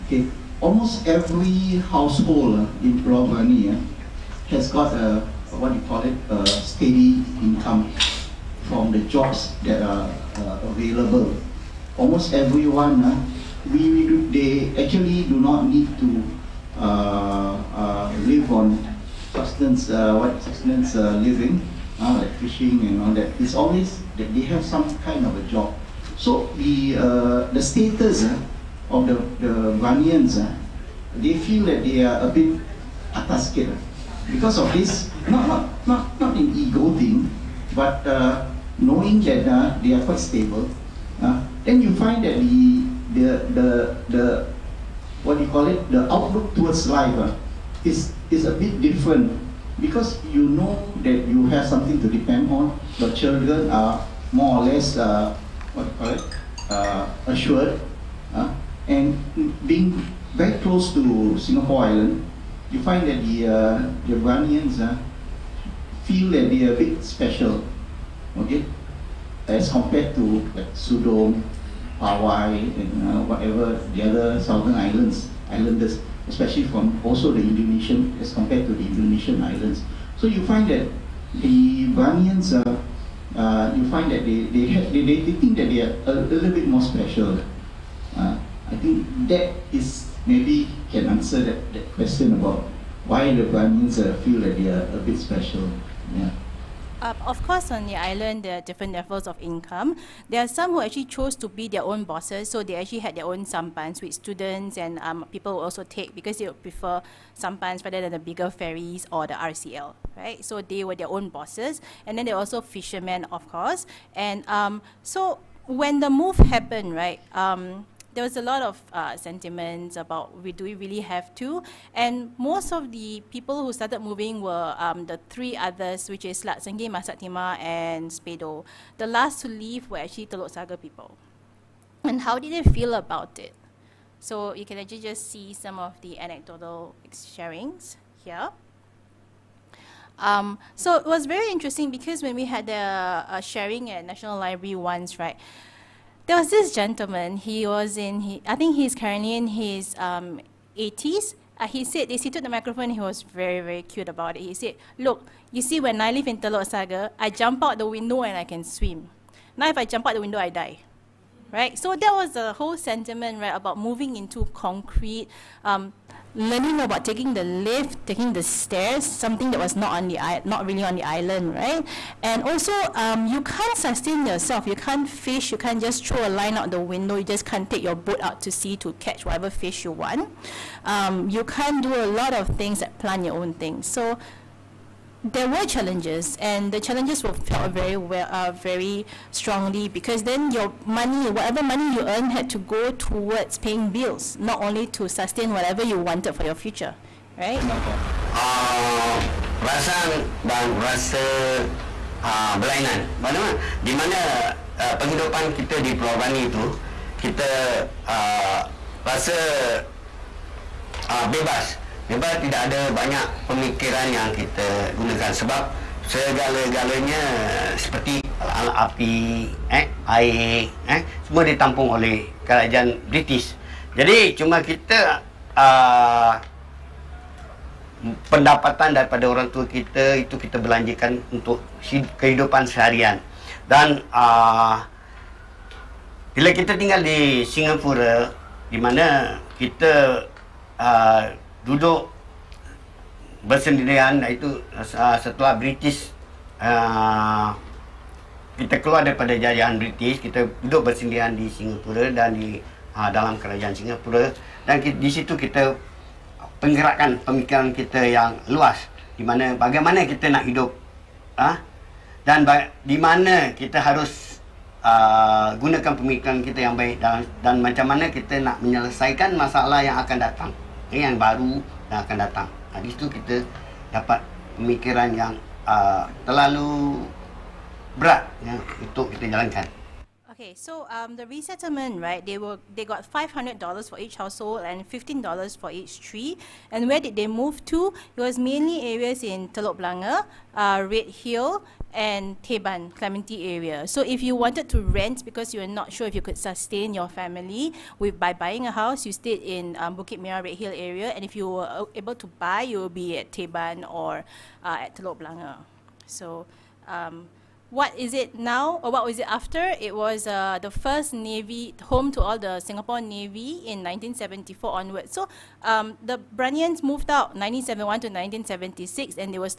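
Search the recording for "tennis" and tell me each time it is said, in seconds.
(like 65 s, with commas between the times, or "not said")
not said.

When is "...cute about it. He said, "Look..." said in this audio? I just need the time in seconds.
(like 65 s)
153 s.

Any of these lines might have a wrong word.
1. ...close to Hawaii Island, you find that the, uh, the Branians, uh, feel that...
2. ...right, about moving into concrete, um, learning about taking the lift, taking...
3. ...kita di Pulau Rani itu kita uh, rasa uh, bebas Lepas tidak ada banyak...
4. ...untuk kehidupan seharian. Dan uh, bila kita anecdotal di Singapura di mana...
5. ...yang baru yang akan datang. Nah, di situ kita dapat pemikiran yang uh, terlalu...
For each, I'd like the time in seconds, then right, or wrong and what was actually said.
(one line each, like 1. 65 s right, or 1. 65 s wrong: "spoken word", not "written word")
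1. 60 s wrong: "Singapore", not "Hawaii"
2. 163 s right
3. 205 s right
4. 231 s wrong: "tinggal", not "anecdotal"
5. 271 s right.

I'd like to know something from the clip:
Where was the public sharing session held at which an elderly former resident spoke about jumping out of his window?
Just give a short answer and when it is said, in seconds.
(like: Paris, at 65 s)
National Library, at 144 s.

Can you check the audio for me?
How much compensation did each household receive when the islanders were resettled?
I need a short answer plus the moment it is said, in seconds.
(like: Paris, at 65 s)
$500, at 283 s.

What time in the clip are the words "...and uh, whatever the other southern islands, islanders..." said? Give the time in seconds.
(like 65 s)
72 s.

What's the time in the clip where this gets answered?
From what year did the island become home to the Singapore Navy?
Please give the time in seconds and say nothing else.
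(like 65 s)
313 s.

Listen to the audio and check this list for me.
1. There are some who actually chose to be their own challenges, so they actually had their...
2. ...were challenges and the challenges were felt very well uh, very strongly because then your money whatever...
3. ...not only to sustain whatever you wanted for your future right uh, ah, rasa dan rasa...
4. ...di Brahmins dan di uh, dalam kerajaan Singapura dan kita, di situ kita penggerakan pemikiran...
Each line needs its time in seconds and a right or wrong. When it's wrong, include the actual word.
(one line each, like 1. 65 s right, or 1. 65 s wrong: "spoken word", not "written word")
1. 100 s wrong: "bosses", not "challenges"
2. 185 s right
3. 194 s right
4. 251 s wrong: "Singapura", not "Brahmins".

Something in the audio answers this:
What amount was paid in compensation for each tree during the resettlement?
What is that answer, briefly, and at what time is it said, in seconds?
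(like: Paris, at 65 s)
$15, at 284 s.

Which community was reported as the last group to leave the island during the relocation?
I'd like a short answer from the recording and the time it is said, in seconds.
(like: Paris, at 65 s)
Telok Saga people, at 130 s.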